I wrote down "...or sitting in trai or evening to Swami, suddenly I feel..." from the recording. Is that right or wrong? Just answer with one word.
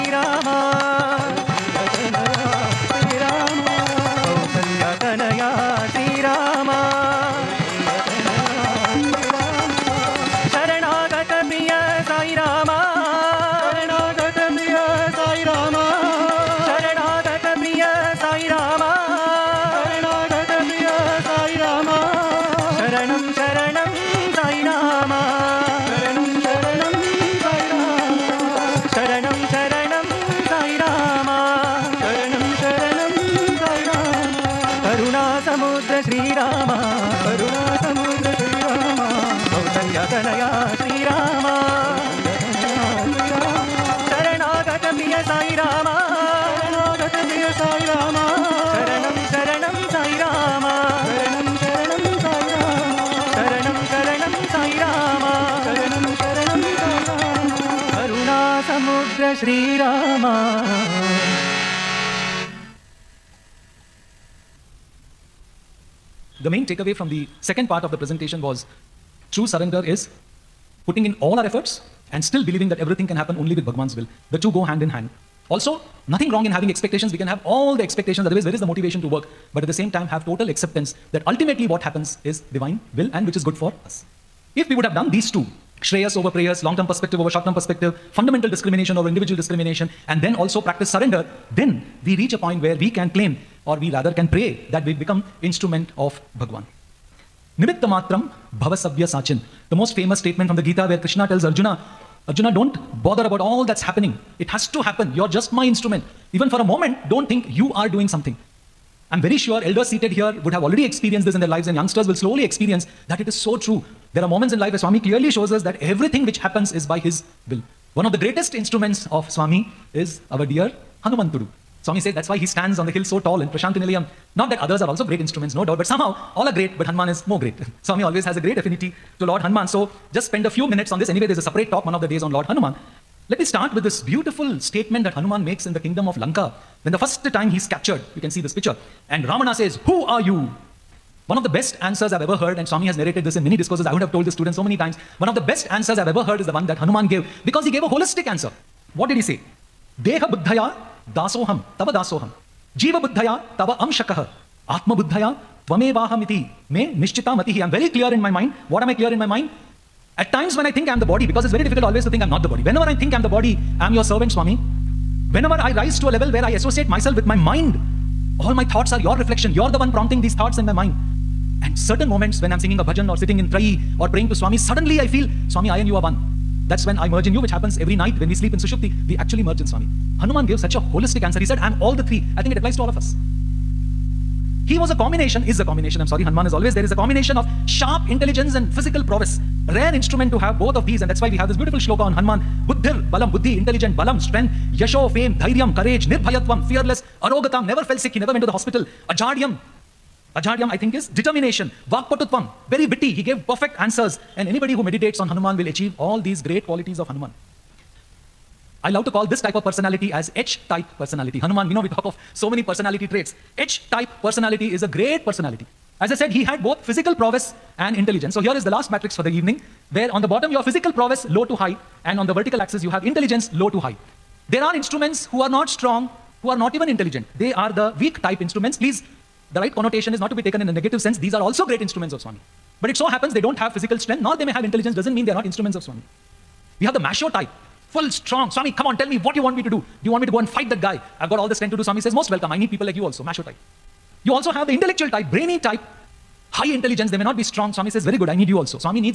wrong.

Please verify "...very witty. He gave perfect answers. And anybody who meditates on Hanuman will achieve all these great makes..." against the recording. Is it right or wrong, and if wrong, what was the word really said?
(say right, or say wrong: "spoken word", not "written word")
wrong: "qualities", not "makes".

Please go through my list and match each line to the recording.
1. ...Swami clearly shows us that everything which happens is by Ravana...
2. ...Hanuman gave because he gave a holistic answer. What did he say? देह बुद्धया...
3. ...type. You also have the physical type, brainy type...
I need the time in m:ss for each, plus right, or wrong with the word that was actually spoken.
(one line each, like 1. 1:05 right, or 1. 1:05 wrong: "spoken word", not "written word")
1. 1:54 wrong: "His", not "Ravana"
2. 2:26 right
3. 4:03 wrong: "intellectual", not "physical".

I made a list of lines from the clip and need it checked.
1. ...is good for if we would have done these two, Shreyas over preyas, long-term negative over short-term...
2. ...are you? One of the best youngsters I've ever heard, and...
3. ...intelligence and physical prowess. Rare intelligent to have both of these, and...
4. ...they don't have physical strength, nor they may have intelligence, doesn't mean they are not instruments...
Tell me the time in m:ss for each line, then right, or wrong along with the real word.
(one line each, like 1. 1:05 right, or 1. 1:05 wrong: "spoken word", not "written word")
1. 1:23 wrong: "perspective", not "negative"
2. 2:20 wrong: "answers", not "youngsters"
3. 3:08 wrong: "instrument", not "intelligent"
4. 3:53 right.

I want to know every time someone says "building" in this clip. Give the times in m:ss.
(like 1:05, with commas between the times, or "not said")
not said.